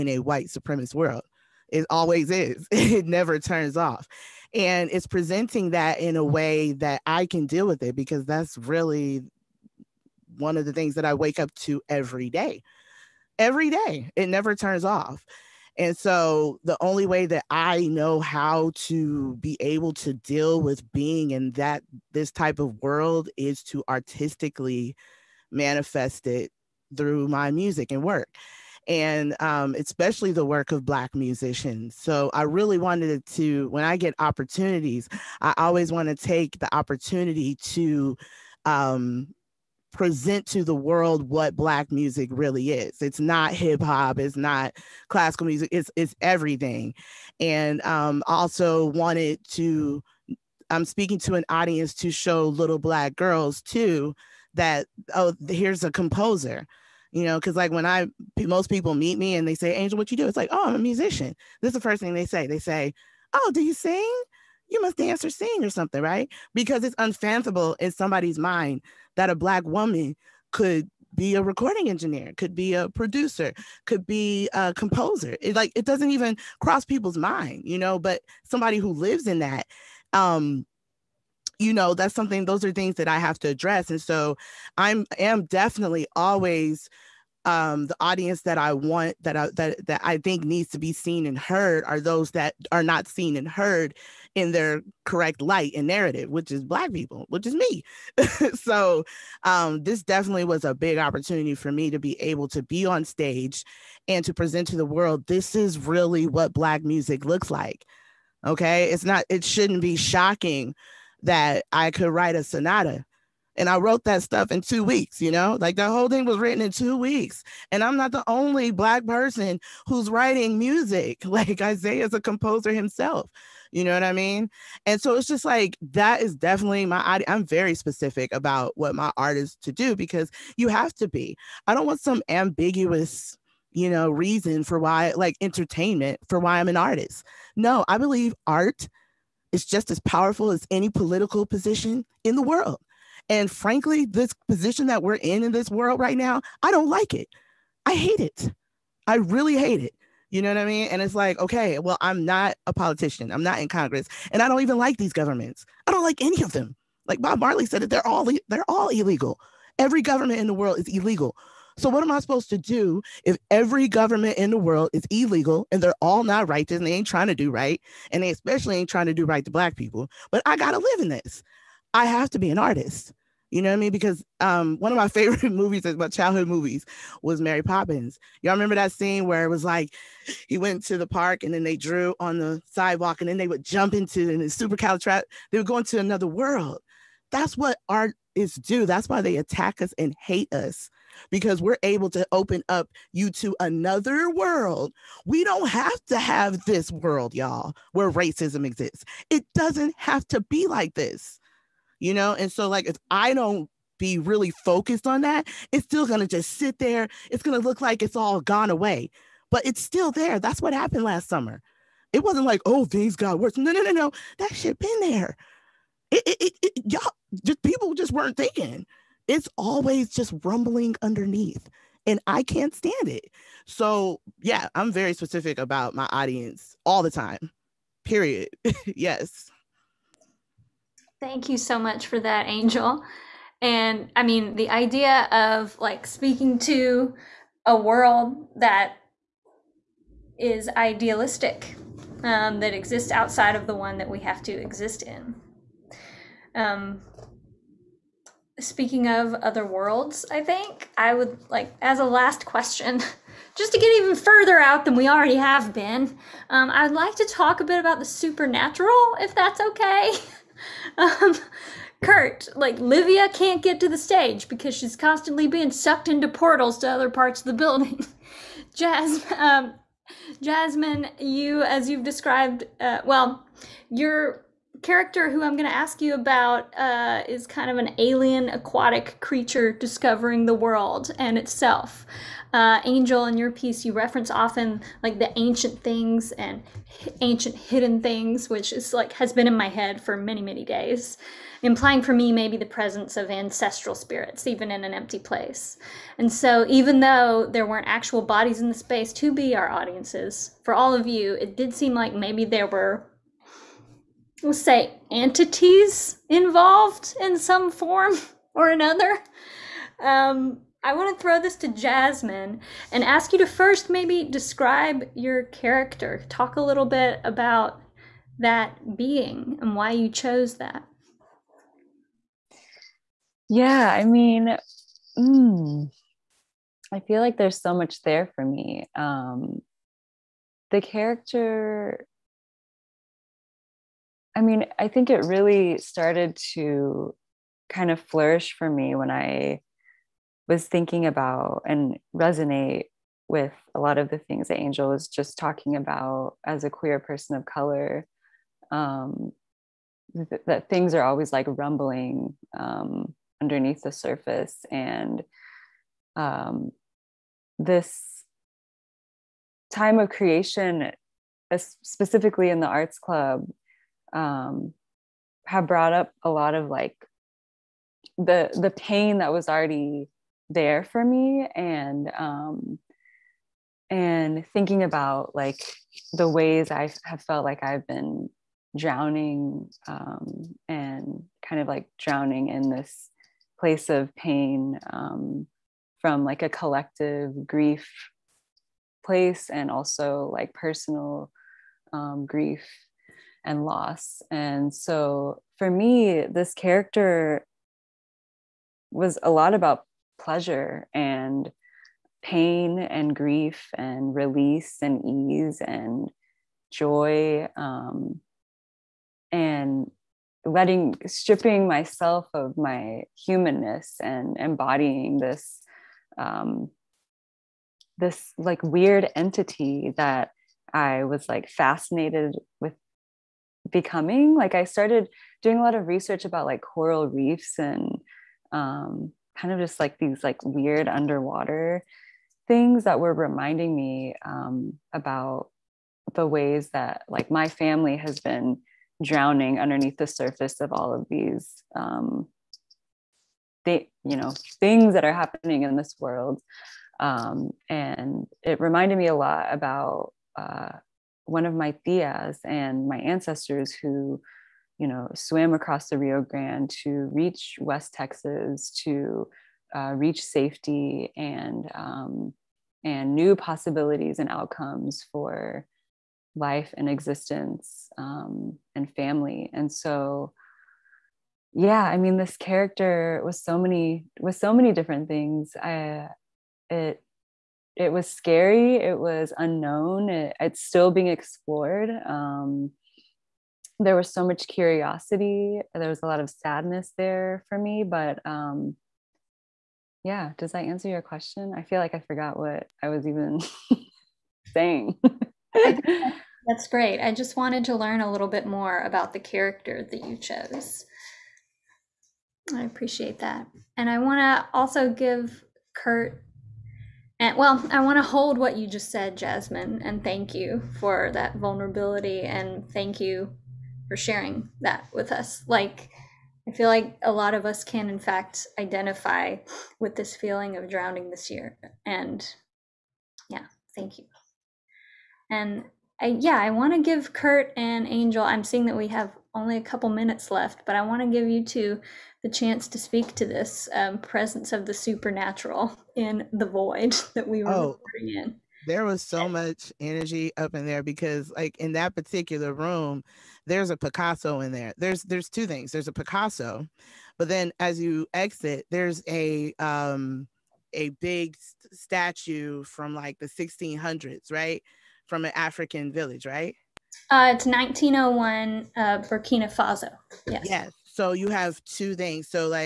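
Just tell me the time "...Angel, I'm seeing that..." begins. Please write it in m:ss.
8:47.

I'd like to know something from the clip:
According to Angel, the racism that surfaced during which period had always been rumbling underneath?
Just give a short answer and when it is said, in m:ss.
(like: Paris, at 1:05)
last summer, at 3:31.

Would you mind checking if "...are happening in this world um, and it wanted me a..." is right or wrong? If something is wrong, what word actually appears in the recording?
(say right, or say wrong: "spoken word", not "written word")
wrong: "reminded", not "wanted".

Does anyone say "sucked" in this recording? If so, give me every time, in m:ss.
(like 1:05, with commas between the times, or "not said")
4:25.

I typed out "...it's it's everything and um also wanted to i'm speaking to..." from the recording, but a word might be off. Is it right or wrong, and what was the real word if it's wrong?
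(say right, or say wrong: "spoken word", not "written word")
right.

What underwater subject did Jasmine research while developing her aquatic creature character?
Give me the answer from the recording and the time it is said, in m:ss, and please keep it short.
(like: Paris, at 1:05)
coral reefs, at 7:06.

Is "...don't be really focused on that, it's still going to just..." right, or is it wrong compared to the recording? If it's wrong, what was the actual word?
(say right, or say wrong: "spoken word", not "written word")
right.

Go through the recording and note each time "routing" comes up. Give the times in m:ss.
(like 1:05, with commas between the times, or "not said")
not said.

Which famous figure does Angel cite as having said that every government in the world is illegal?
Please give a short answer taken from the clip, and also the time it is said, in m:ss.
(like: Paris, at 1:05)
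Bob Marley, at 2:37.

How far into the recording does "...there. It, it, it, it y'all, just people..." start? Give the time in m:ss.
3:34.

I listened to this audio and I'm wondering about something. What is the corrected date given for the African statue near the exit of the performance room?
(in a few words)
1901.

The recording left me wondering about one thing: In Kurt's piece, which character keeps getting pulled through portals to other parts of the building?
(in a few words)
Livia.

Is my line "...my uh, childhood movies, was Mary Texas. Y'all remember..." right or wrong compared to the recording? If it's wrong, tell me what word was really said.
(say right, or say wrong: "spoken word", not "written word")
wrong: "Poppins", not "Texas".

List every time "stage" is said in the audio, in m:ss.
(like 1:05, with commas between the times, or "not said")
1:43, 4:23.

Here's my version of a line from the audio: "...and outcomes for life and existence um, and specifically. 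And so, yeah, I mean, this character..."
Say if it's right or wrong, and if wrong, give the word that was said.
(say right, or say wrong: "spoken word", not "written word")
wrong: "family", not "specifically".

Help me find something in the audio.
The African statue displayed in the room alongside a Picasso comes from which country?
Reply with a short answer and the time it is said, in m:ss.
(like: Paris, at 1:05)
Burkina Faso, at 9:18.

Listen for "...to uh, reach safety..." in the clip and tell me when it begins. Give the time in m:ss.
7:38.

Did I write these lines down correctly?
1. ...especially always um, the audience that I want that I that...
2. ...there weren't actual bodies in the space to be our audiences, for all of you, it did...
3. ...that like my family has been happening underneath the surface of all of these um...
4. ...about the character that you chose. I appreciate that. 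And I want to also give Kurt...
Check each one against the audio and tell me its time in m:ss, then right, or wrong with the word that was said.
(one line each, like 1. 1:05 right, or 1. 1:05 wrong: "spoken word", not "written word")
1. 1:25 wrong: "definitely", not "especially"
2. 4:57 right
3. 7:16 wrong: "drowning", not "happening"
4. 8:18 right.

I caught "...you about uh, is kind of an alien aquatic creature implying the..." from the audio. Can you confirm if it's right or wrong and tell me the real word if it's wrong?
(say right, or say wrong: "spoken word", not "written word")
wrong: "discovering", not "implying".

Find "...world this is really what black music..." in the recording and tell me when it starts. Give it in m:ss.
1:44.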